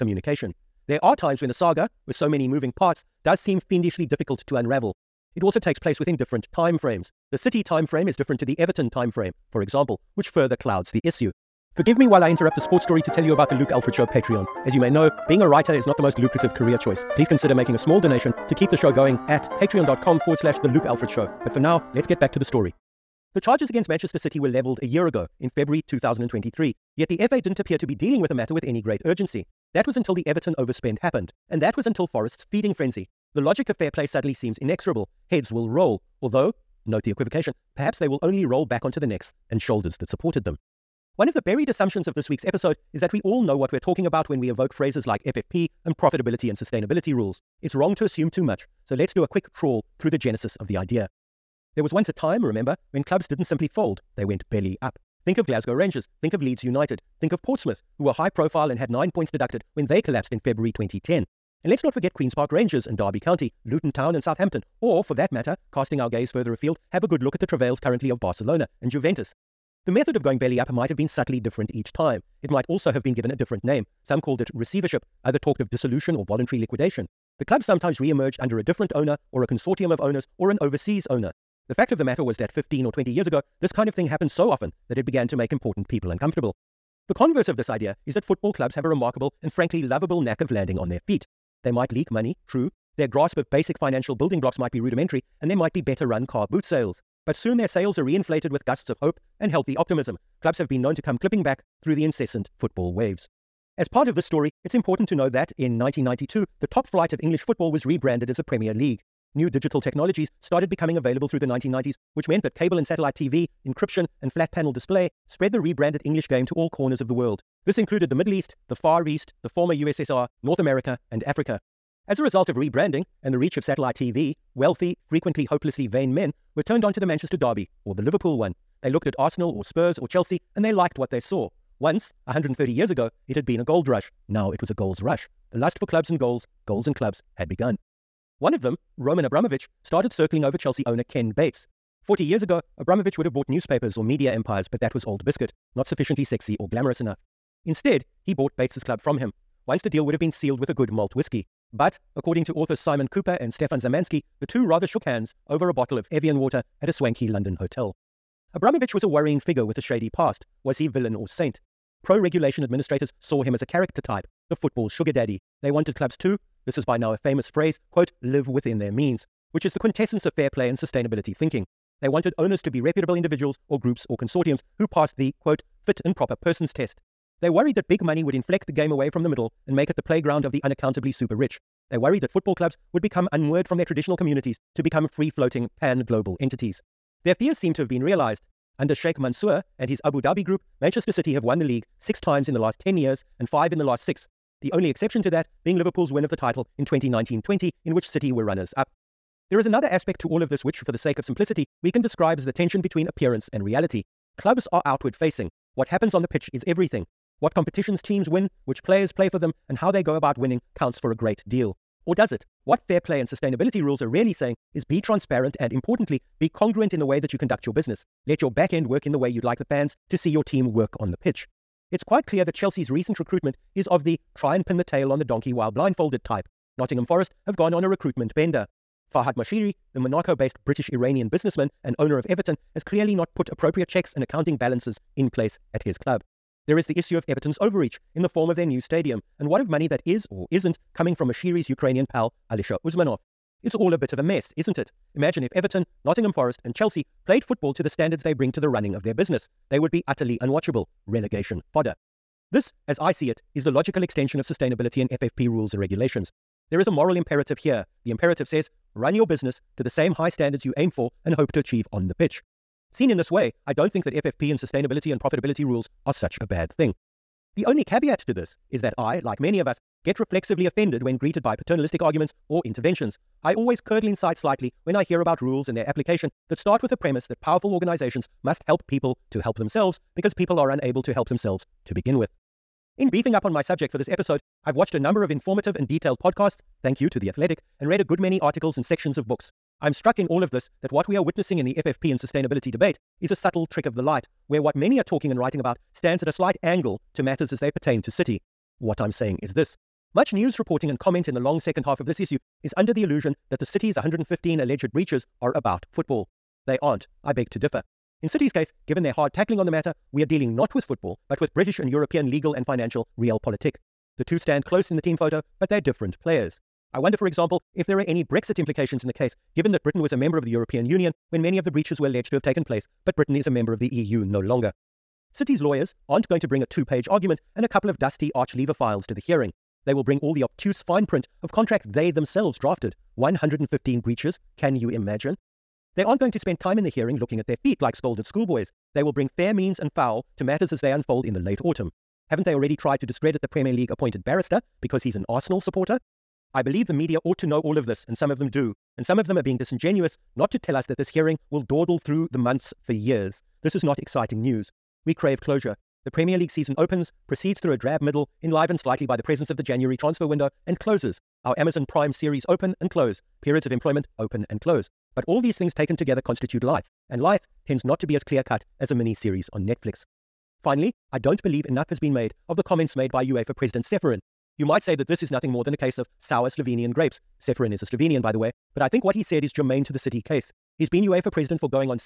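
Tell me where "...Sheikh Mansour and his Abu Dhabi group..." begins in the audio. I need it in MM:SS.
03:08.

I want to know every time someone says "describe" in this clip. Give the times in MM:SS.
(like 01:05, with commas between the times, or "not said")
03:22.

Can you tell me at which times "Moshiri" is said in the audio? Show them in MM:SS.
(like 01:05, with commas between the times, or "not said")
03:49, 04:01.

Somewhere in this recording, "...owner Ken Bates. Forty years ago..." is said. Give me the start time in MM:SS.
02:20.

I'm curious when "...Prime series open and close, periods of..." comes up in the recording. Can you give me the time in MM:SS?
06:01.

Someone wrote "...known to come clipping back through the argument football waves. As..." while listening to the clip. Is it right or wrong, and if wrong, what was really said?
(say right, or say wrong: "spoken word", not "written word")
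wrong: "incessant", not "argument".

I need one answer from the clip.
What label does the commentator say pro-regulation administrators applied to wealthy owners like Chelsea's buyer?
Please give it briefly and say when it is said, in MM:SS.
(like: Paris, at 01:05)
football sugar daddy, at 02:44.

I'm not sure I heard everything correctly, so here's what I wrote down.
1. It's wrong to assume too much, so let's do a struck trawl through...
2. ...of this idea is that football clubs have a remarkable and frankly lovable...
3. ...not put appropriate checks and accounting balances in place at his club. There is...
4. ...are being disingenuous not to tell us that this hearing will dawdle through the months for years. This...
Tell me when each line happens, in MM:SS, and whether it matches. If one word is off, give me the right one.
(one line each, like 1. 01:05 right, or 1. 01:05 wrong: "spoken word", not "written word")
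1. 00:47 wrong: "quick", not "struck"
2. 01:27 right
3. 03:53 right
4. 05:49 right.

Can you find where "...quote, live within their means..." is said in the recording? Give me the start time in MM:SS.
02:47.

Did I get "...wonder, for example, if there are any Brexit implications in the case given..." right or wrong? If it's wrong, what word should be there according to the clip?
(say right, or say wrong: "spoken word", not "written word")
right.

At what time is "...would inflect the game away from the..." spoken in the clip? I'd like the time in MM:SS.
02:58.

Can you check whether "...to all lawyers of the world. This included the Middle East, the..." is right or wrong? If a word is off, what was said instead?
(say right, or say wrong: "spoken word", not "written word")
wrong: "corners", not "lawyers".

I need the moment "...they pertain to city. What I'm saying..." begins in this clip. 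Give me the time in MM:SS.
04:57.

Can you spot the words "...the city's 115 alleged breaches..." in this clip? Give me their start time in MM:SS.
05:03.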